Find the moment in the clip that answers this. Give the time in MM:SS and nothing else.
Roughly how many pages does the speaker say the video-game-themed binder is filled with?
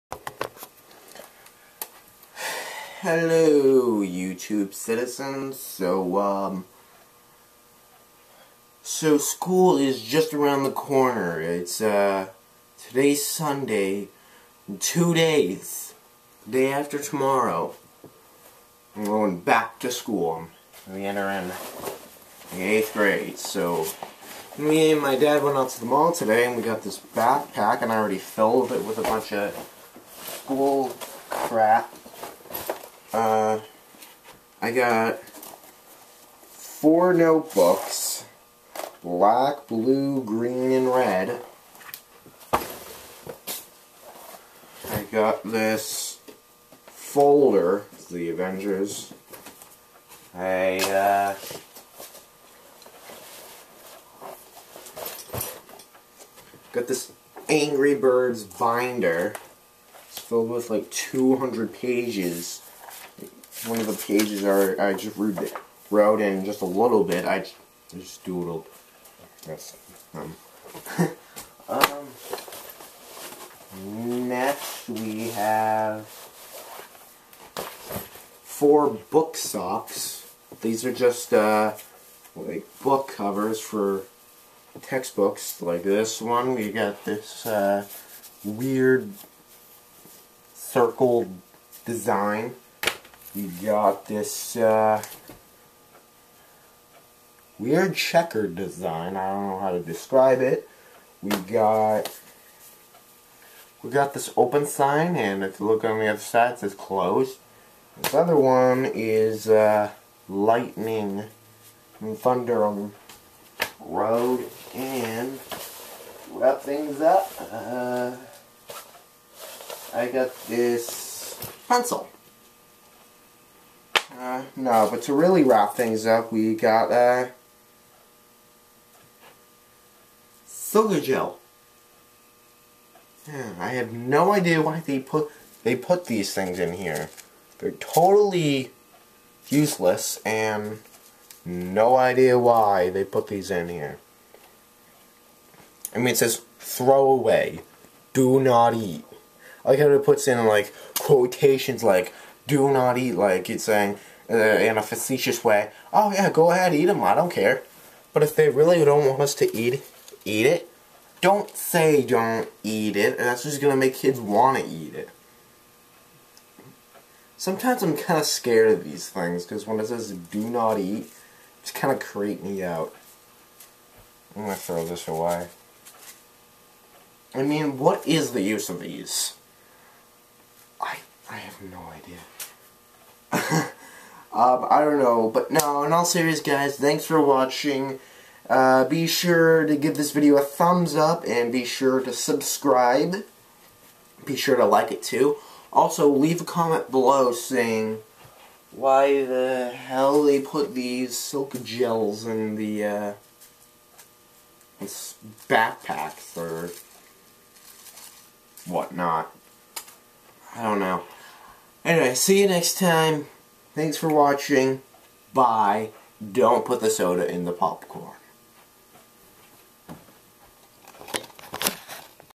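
01:00.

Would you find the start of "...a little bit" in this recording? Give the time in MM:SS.
01:06.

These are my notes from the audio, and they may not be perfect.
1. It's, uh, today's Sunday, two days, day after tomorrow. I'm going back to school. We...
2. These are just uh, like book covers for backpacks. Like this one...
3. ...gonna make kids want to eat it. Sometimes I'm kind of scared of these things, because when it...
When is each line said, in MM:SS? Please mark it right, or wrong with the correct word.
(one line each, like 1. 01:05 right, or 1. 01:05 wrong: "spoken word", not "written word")
1. 00:11 right
2. 01:20 wrong: "textbooks", not "backpacks"
3. 02:43 right.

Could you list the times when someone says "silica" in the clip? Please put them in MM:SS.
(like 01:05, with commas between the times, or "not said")
02:10, 03:21.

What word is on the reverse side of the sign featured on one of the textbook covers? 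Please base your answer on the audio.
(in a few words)
Closed.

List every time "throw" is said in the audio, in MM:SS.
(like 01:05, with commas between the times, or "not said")
02:26, 02:54.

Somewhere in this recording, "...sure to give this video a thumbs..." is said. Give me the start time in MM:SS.
03:09.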